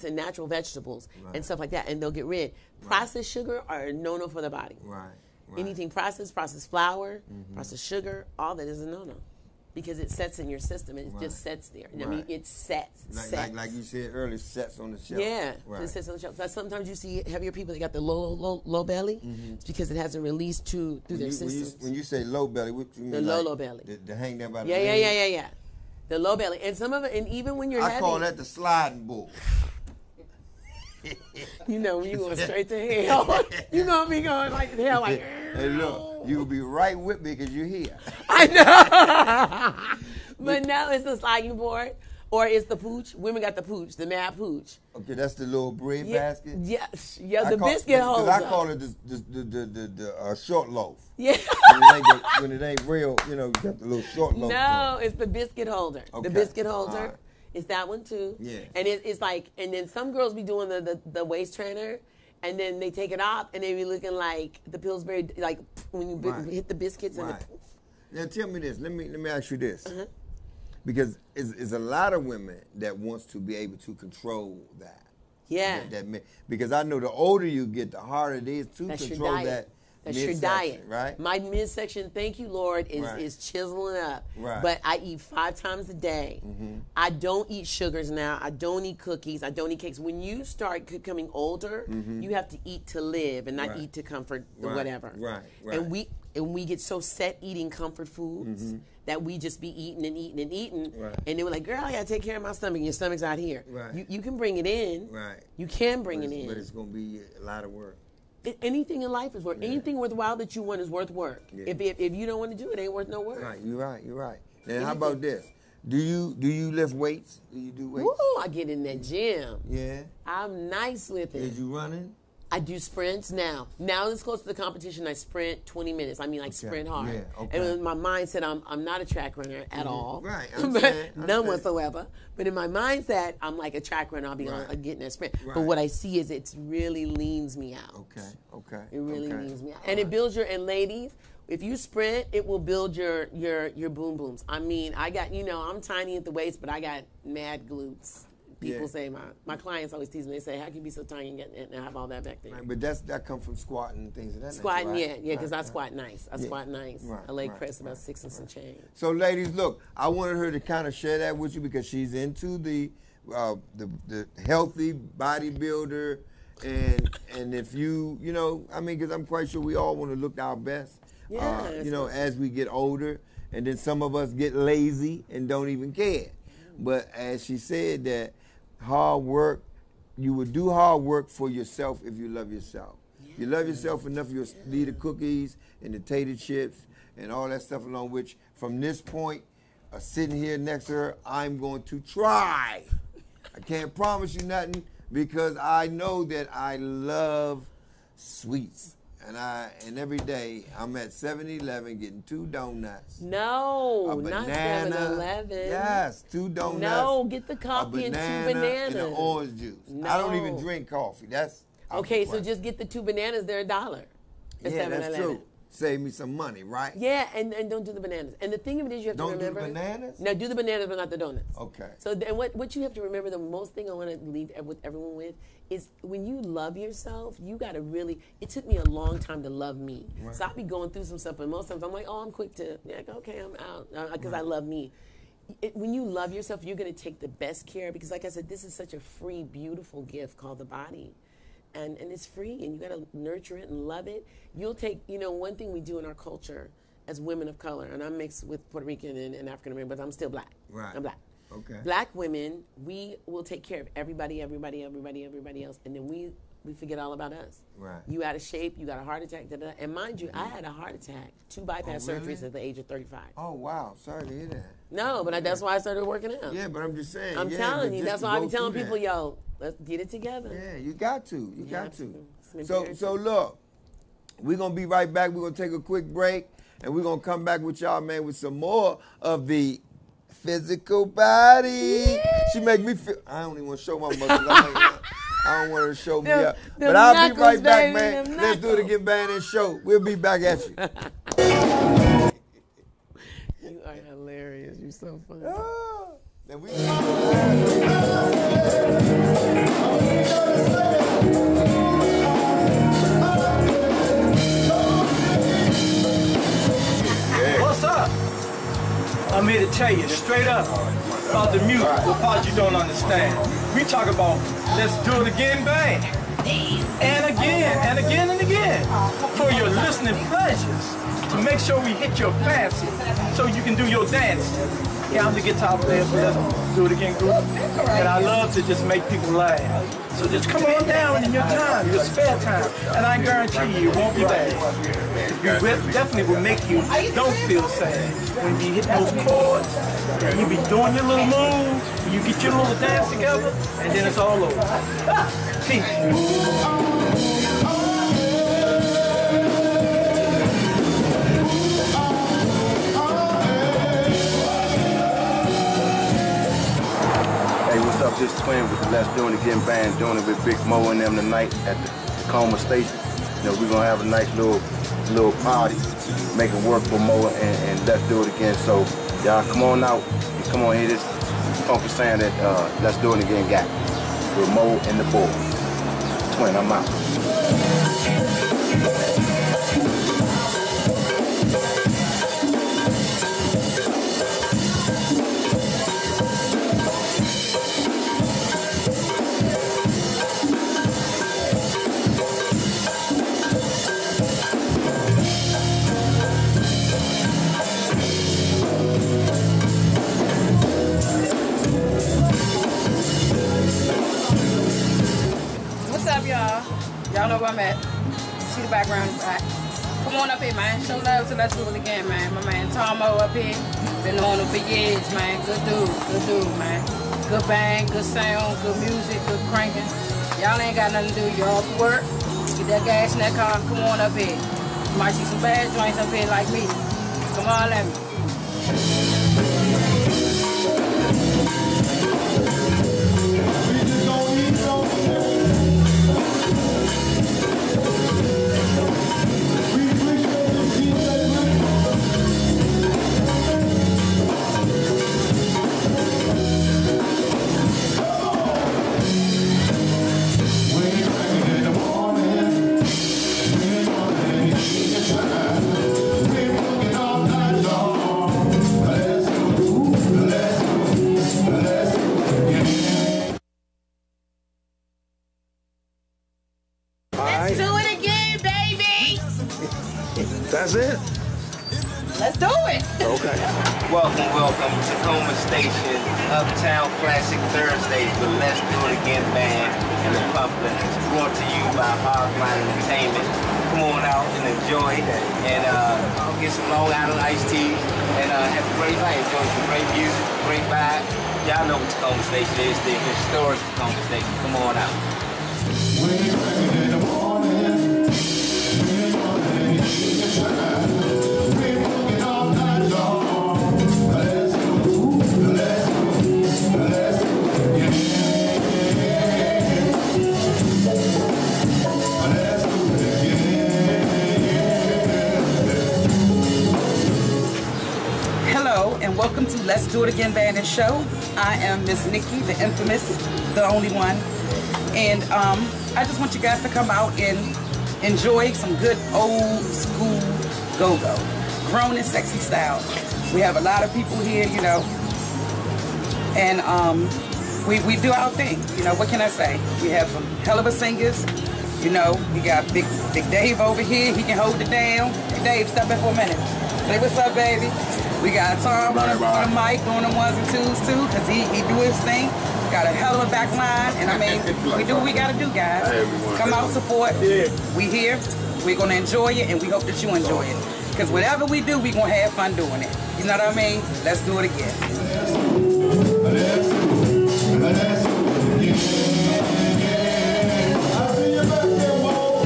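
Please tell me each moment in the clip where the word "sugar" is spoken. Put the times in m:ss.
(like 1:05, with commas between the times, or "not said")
0:03, 0:07, 1:27.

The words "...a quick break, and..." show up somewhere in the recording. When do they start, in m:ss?
4:35.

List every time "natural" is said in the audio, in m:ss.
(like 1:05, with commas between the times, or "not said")
0:00.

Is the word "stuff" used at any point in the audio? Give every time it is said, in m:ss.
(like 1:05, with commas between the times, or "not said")
0:01, 3:07, 3:51.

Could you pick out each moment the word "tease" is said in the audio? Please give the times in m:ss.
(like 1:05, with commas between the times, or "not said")
2:30.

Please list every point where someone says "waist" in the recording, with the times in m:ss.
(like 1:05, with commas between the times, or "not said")
1:01, 2:26.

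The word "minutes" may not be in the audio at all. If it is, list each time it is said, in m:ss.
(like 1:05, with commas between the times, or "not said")
2:05, 9:06.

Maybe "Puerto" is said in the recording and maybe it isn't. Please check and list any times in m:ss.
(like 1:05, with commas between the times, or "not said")
4:08.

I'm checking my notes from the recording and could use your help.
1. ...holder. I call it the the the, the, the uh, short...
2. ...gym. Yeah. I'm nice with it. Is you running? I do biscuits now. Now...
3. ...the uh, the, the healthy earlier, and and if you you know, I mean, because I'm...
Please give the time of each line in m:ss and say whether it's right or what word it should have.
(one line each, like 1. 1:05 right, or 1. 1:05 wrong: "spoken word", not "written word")
1. 0:48 right
2. 1:59 wrong: "sprints", not "biscuits"
3. 2:42 wrong: "bodybuilder", not "earlier".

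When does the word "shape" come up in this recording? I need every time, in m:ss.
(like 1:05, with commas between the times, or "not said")
4:18.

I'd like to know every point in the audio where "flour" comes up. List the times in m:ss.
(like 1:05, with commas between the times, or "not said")
0:06.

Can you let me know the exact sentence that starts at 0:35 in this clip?
Hey, look, you'll be right with me because you're here.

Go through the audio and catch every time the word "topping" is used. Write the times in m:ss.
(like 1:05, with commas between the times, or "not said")
not said.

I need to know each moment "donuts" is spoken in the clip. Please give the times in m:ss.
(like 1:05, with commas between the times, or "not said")
3:22, 3:26, 3:41.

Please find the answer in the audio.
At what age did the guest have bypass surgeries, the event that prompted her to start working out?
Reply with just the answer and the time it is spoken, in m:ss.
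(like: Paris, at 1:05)
35, at 4:22.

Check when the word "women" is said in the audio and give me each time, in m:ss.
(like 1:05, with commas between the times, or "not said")
0:43, 1:12, 4:07, 4:12.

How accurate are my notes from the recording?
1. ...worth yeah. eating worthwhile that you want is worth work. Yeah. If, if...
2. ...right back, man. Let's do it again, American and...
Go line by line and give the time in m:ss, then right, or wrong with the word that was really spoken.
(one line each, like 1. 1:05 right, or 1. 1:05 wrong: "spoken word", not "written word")
1. 1:49 wrong: "anything", not "eating"
2. 4:47 wrong: "Band", not "American".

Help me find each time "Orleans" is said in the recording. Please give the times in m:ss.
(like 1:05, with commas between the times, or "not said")
not said.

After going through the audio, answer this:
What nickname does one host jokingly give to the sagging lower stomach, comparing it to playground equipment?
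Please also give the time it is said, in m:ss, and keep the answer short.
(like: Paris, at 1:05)
sliding board, at 0:41.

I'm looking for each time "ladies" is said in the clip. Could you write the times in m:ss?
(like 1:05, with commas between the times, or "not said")
2:20, 2:39.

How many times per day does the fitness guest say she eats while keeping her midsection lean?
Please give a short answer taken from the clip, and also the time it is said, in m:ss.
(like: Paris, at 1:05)
5, at 1:25.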